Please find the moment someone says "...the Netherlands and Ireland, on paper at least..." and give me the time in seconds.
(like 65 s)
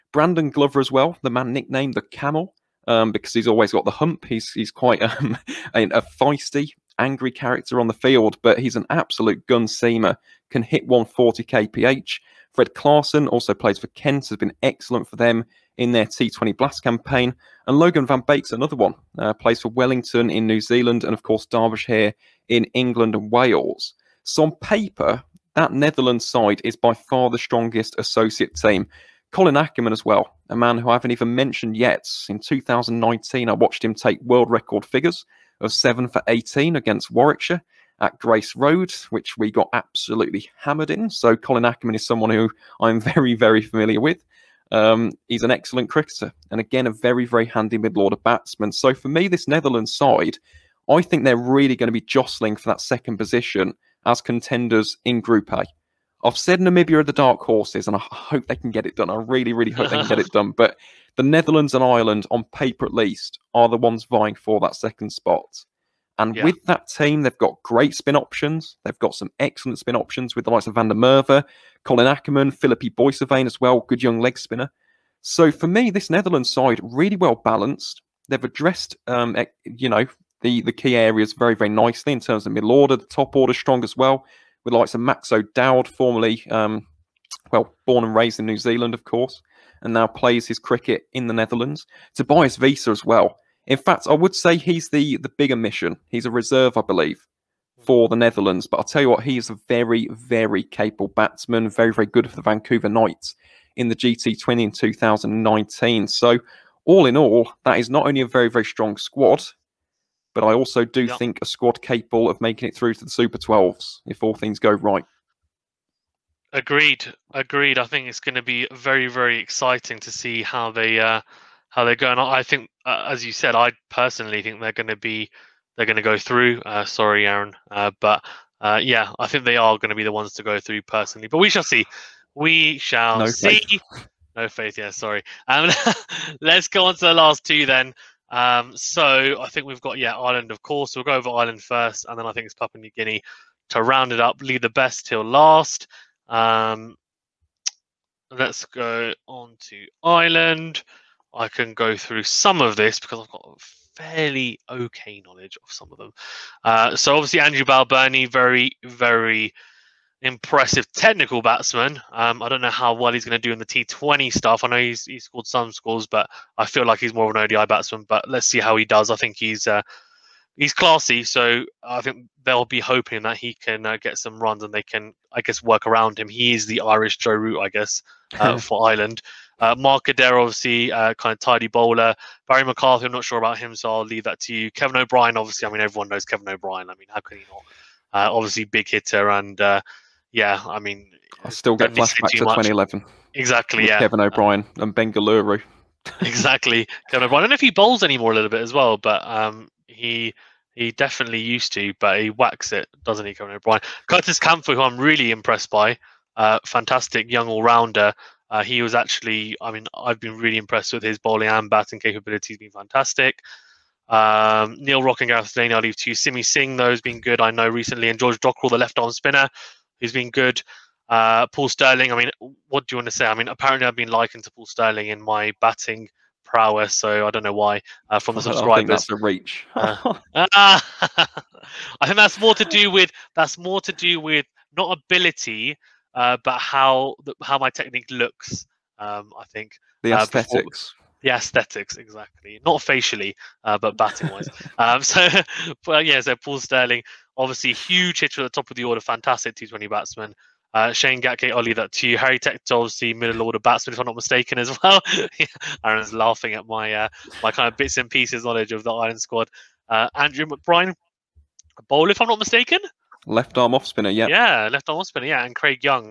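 61 s.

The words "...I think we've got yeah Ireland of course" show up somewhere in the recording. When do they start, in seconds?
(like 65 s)
139 s.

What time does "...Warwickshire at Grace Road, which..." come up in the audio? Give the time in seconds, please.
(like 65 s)
37 s.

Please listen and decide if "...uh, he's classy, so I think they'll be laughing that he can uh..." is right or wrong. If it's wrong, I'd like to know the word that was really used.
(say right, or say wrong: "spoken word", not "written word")
wrong: "hoping", not "laughing".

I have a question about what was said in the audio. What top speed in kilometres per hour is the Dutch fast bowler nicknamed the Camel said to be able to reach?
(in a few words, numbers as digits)
140 kph.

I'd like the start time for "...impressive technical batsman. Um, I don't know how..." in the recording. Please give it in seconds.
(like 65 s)
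160 s.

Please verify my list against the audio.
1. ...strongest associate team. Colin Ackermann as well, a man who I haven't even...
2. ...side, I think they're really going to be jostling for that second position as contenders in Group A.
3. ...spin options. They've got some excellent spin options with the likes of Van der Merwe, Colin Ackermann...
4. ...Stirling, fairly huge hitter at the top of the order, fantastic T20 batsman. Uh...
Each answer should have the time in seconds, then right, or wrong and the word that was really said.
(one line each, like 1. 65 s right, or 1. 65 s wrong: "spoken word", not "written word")
1. 27 s right
2. 49 s right
3. 67 s right
4. 246 s wrong: "obviously", not "fairly".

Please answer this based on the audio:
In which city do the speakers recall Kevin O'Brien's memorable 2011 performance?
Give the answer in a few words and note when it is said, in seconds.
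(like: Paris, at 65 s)
Bengaluru, at 194 s.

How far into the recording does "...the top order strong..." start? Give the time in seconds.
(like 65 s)
82 s.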